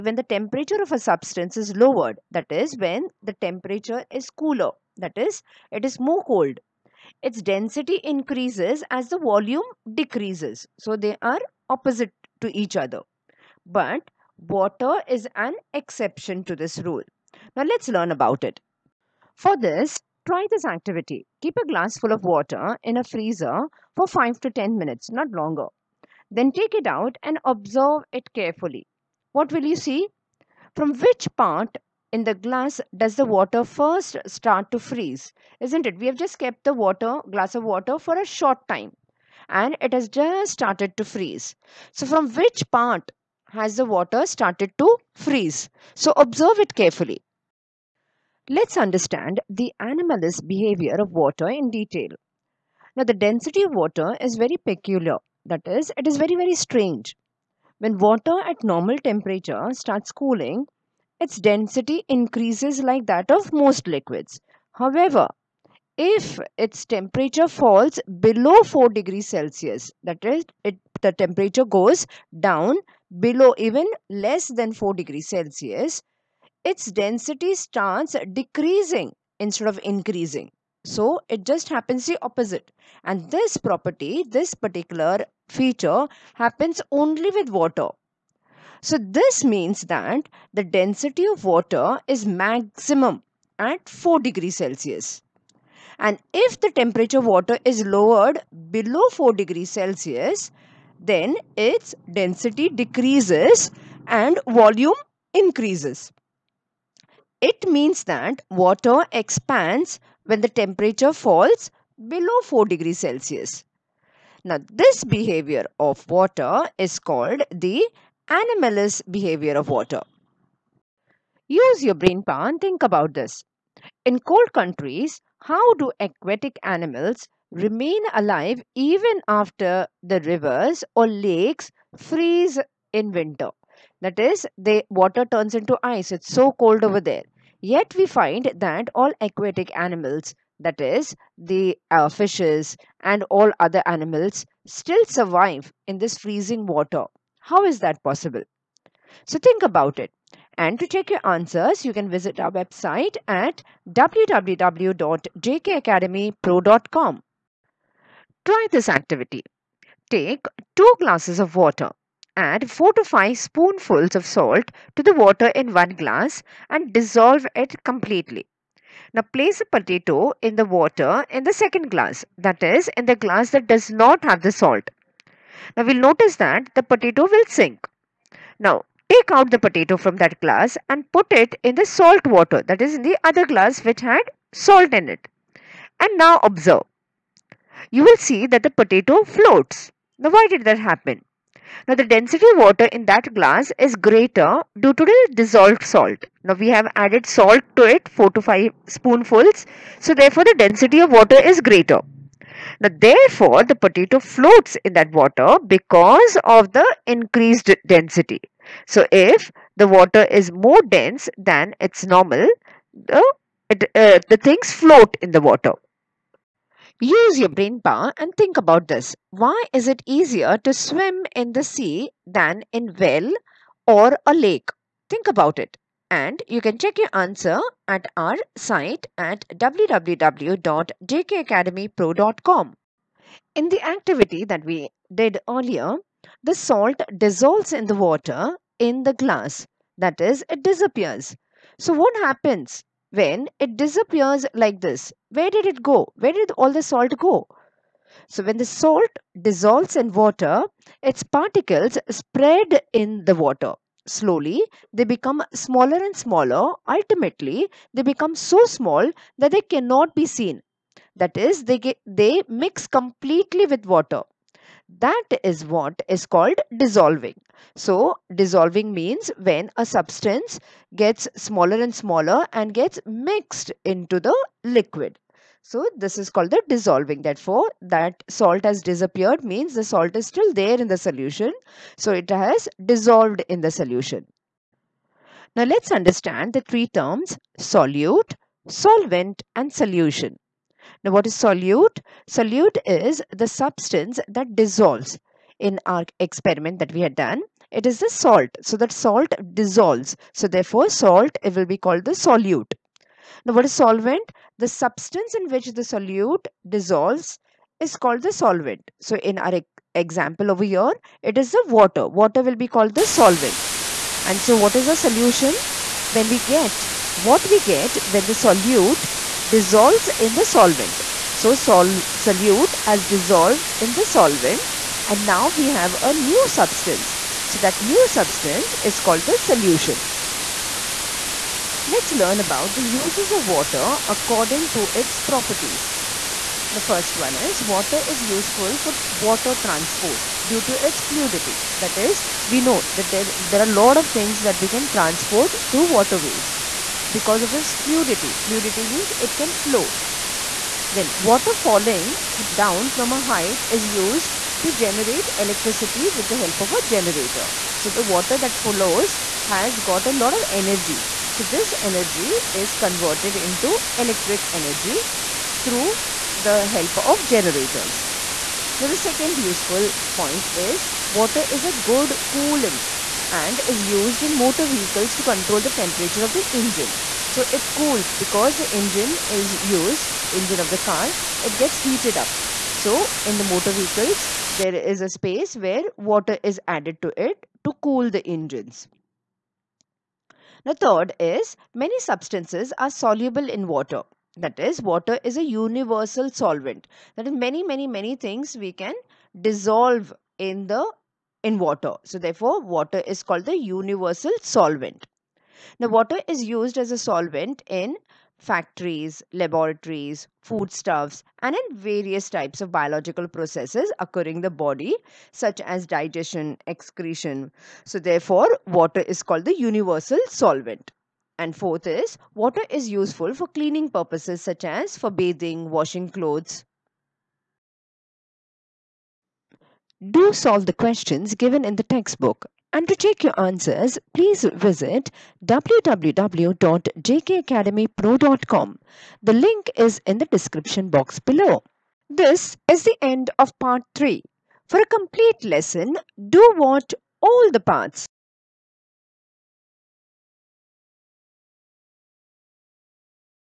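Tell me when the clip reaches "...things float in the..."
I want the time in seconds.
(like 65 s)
214 s.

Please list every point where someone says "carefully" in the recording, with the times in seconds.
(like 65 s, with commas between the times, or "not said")
28 s, 46 s.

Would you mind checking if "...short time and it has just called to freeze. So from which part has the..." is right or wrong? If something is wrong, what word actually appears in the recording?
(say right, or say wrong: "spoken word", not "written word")
wrong: "started", not "called".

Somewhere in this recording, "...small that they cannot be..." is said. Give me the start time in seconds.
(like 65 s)
258 s.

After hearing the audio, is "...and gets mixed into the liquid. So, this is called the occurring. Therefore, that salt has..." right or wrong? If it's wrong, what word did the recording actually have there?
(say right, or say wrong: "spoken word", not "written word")
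wrong: "dissolving", not "occurring".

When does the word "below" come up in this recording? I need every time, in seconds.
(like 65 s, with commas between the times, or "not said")
68 s, 73 s, 98 s, 112 s, 441 s.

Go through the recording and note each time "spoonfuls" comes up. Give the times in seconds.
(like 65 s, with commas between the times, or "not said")
163 s, 198 s.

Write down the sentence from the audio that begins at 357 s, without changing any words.
So the water that follows has got a lot of energy.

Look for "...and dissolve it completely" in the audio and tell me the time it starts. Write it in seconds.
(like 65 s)
166 s.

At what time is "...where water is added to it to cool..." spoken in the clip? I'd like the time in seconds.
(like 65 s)
385 s.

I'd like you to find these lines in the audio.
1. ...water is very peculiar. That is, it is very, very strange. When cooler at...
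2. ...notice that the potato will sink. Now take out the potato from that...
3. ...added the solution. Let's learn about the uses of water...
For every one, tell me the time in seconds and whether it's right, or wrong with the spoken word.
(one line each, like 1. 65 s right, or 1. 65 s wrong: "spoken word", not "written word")
1. 53 s wrong: "water", not "cooler"
2. 175 s right
3. 328 s wrong: "called", not "added".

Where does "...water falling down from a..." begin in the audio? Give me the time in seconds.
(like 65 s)
351 s.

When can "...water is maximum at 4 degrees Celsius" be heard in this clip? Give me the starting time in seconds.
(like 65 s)
91 s.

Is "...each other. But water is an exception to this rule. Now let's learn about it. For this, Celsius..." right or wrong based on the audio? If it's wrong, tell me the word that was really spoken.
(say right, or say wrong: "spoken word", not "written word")
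wrong: "Try", not "Celsius".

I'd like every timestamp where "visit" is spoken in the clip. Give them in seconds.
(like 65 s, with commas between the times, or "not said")
152 s, 434 s.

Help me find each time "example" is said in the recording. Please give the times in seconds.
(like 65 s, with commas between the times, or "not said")
309 s.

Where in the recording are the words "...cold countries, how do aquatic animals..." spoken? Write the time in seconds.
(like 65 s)
124 s.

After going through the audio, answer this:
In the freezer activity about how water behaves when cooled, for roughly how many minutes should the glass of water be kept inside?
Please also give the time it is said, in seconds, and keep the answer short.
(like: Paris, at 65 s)
5 to 10 minutes, at 24 s.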